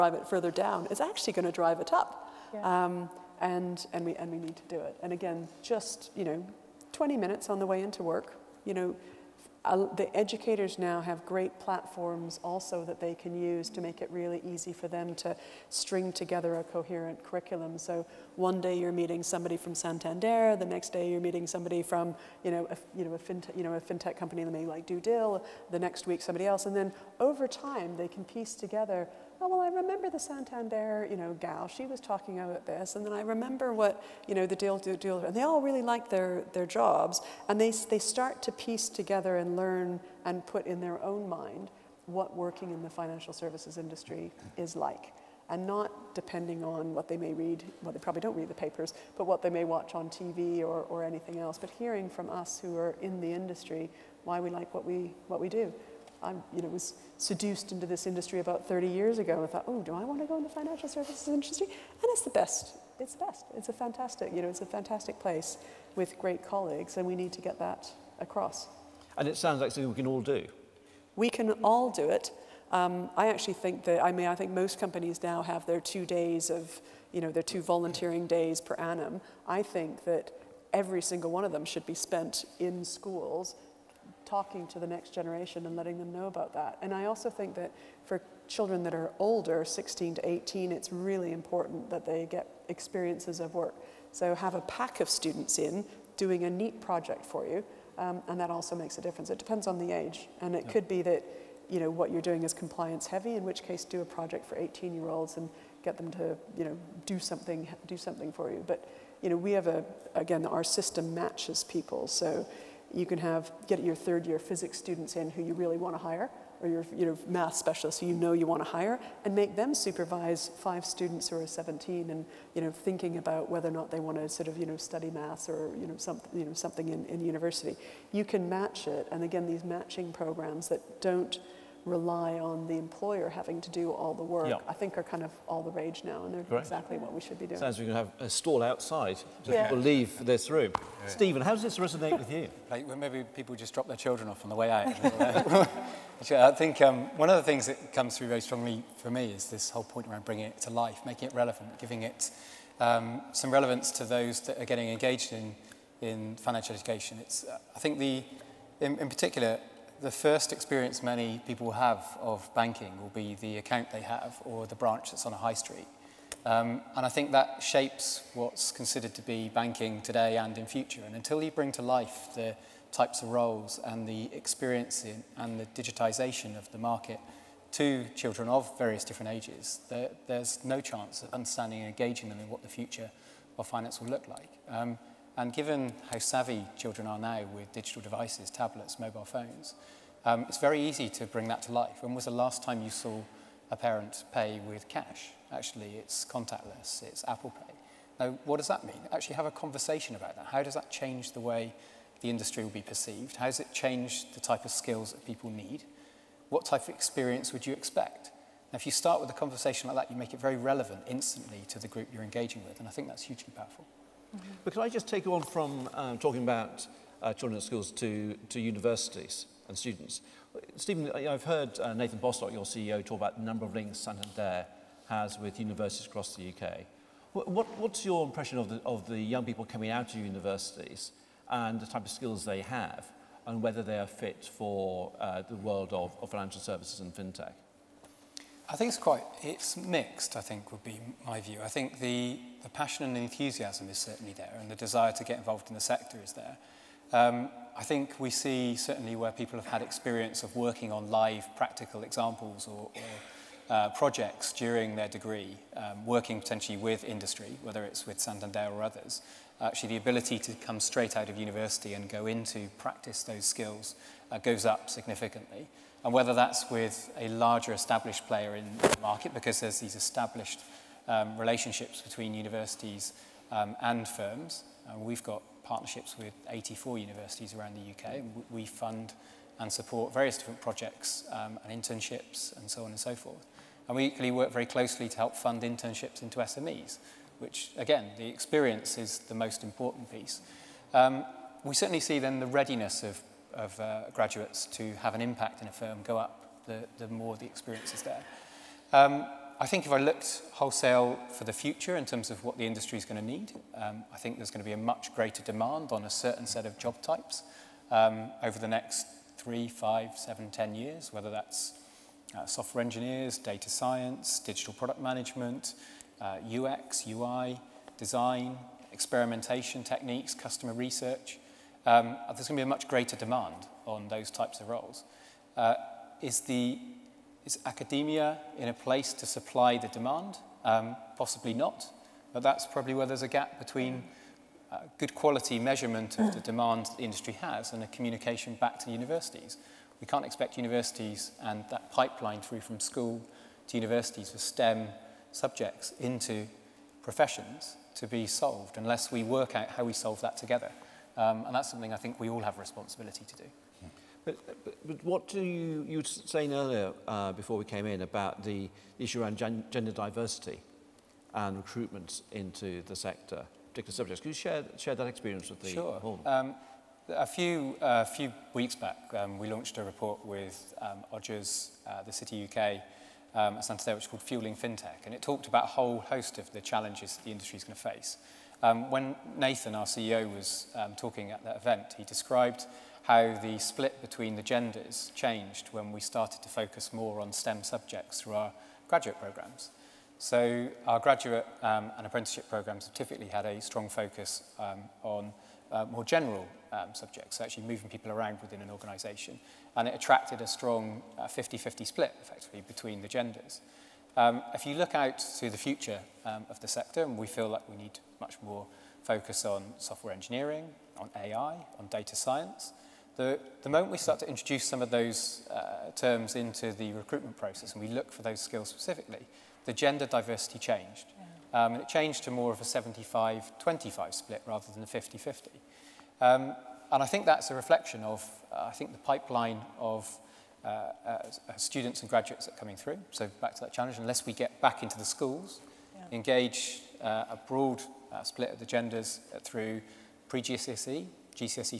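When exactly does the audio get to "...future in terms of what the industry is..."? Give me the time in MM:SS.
05:01.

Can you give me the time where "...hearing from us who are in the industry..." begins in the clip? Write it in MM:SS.
00:51.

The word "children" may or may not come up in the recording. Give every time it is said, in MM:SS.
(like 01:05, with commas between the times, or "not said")
01:28, 02:23, 02:58, 03:06, 03:37.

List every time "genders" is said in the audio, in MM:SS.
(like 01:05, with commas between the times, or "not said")
05:59, 06:24, 06:43, 06:59, 07:18.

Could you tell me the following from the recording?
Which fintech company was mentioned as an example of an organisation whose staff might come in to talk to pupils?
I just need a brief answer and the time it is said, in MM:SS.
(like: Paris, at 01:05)
DueDil, at 00:24.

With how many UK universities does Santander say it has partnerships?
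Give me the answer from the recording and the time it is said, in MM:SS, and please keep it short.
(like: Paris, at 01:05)
84, at 04:36.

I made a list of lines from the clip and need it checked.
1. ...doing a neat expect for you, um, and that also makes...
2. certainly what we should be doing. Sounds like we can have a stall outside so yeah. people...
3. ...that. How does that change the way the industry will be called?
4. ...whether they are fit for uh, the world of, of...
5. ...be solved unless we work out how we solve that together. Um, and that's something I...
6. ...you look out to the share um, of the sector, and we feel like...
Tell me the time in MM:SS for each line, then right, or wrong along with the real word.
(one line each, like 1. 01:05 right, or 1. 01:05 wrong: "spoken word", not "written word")
1. 01:36 wrong: "project", not "expect"
2. 02:16 wrong: "exactly", not "certainly"
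3. 03:20 wrong: "perceived", not "called"
4. 03:53 right
5. 05:48 right
6. 06:44 wrong: "future", not "share".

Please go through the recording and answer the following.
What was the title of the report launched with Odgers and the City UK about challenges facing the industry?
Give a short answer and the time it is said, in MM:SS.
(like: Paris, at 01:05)
Fueling FinTech, at 06:14.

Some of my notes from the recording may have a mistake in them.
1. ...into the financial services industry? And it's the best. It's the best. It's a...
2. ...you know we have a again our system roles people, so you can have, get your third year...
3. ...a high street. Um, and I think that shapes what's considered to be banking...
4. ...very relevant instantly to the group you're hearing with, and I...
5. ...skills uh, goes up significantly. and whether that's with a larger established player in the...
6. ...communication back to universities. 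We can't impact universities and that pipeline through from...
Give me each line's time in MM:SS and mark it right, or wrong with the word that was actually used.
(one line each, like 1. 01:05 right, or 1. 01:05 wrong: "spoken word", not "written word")
1. 01:00 right
2. 01:49 wrong: "matches", not "roles"
3. 02:45 right
4. 03:30 wrong: "engaging", not "hearing"
5. 04:23 right
6. 05:37 wrong: "expect", not "impact".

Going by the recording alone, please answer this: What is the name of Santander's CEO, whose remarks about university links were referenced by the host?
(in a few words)
Nathan Bostock.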